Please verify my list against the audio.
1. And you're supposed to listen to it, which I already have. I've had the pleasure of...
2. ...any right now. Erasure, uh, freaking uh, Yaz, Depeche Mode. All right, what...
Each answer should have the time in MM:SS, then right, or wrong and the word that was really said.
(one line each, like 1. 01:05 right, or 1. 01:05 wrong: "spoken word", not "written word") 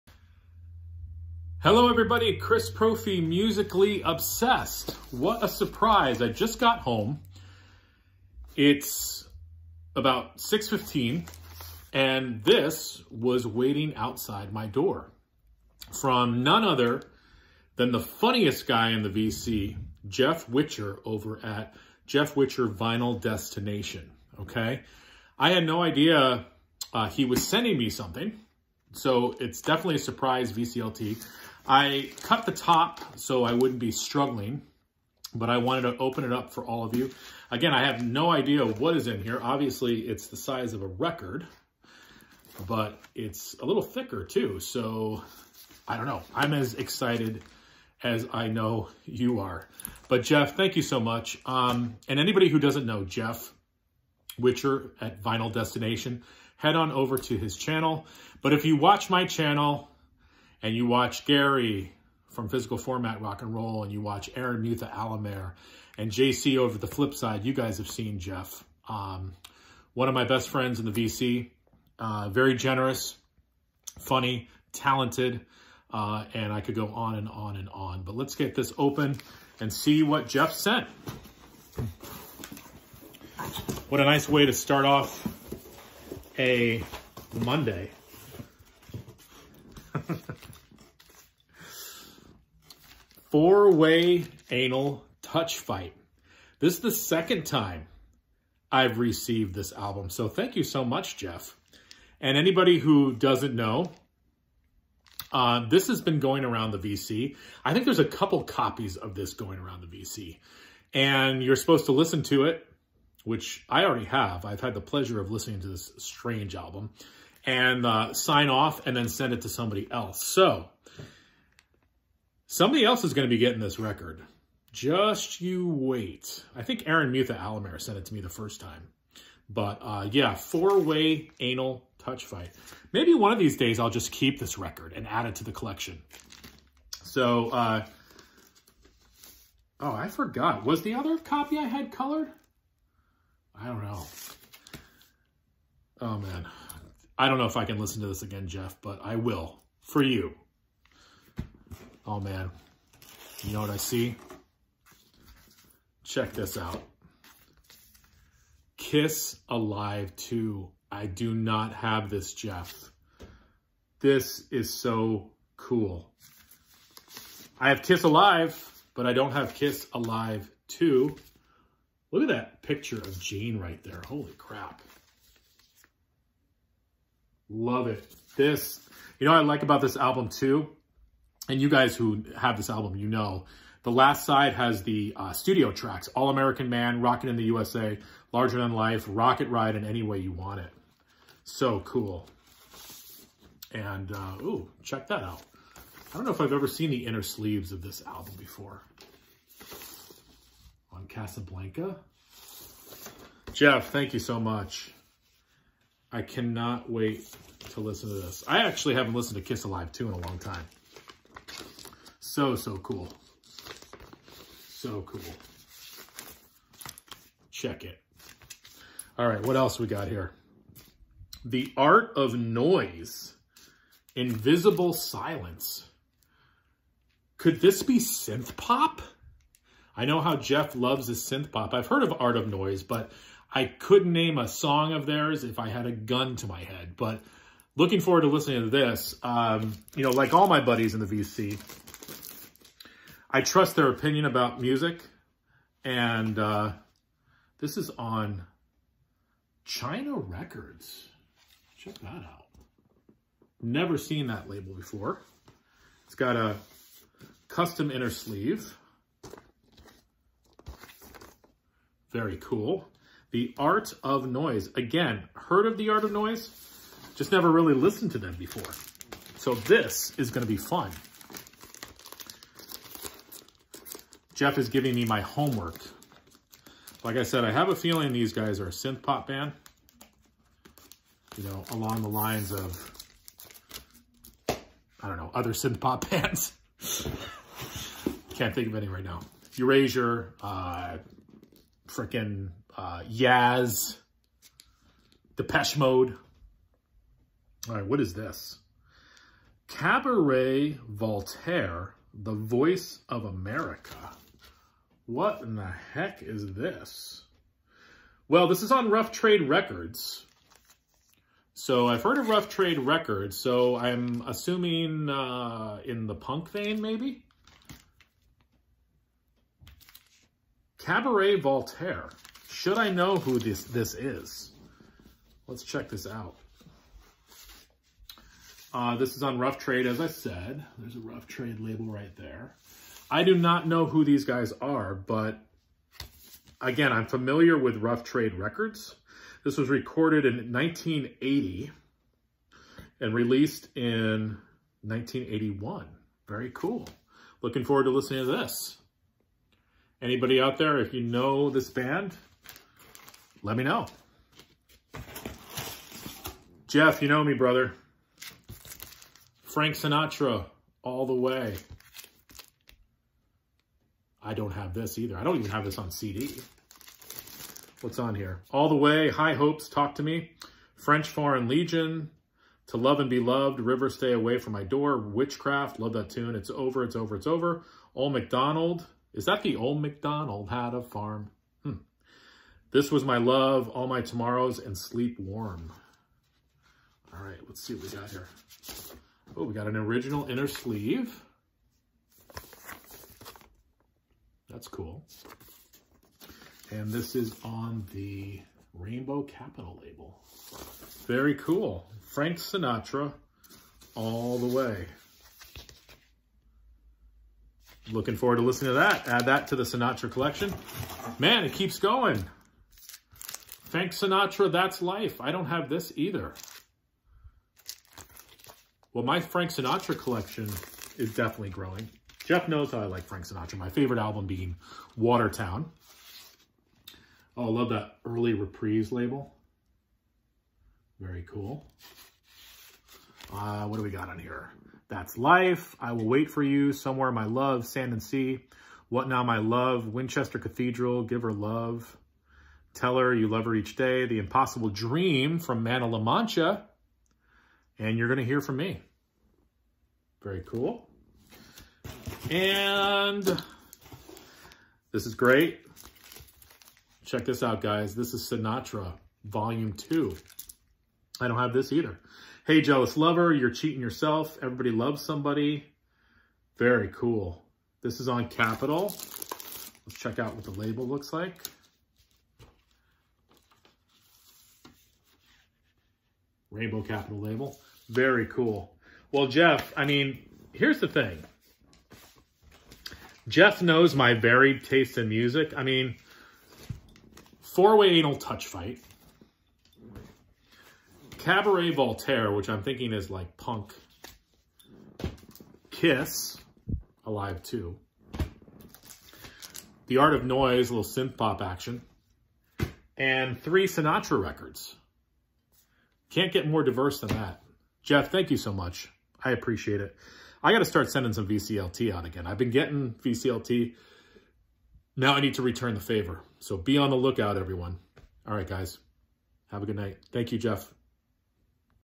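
1. 01:50 right
2. 04:48 right.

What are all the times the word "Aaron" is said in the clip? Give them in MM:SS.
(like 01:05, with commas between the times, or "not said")
01:04, 02:06.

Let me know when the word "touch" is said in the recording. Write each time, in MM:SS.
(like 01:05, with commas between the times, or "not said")
01:35, 02:11, 08:08.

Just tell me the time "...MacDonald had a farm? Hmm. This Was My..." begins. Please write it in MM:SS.
06:19.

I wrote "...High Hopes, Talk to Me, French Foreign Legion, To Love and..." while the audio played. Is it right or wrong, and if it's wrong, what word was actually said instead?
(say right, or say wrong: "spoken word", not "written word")
right.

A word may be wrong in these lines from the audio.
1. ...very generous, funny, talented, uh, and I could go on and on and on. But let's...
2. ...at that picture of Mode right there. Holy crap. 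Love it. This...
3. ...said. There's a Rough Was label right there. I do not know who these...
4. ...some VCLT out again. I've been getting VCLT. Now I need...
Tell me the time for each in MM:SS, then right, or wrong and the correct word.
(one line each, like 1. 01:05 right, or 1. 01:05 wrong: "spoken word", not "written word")
1. 01:12 right
2. 02:52 wrong: "Jane", not "Mode"
3. 05:30 wrong: "Trade", not "Was"
4. 08:31 right.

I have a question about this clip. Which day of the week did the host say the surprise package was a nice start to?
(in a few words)
Monday.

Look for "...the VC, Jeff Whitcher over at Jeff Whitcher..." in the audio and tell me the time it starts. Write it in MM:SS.
00:19.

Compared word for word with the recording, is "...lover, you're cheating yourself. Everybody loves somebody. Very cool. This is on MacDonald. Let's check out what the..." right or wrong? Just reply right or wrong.
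wrong.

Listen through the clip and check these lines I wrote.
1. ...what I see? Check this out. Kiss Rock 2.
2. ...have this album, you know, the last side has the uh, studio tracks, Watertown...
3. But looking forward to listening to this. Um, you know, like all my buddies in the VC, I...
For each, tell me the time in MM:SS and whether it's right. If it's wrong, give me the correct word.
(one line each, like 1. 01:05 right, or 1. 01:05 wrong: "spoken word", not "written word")
1. 02:33 wrong: "Alive", not "Rock"
2. 03:02 wrong: "All", not "Watertown"
3. 03:56 right.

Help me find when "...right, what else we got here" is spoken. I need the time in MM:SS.
03:39.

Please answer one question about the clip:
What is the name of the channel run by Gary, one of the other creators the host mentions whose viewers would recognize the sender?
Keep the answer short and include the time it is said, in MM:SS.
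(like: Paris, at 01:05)
Physical Format Rock and Roll, at 01:02.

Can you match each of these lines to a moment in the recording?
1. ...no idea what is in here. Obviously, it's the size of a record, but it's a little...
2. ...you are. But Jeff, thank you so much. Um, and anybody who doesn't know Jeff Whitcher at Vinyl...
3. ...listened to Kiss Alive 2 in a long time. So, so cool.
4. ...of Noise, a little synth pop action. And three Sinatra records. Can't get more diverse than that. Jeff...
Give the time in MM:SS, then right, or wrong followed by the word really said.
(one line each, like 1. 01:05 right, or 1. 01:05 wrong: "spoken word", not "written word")
1. 00:38 right
2. 00:49 right
3. 03:29 right
4. 08:20 right.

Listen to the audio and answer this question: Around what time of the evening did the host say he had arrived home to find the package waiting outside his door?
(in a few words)
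6:15.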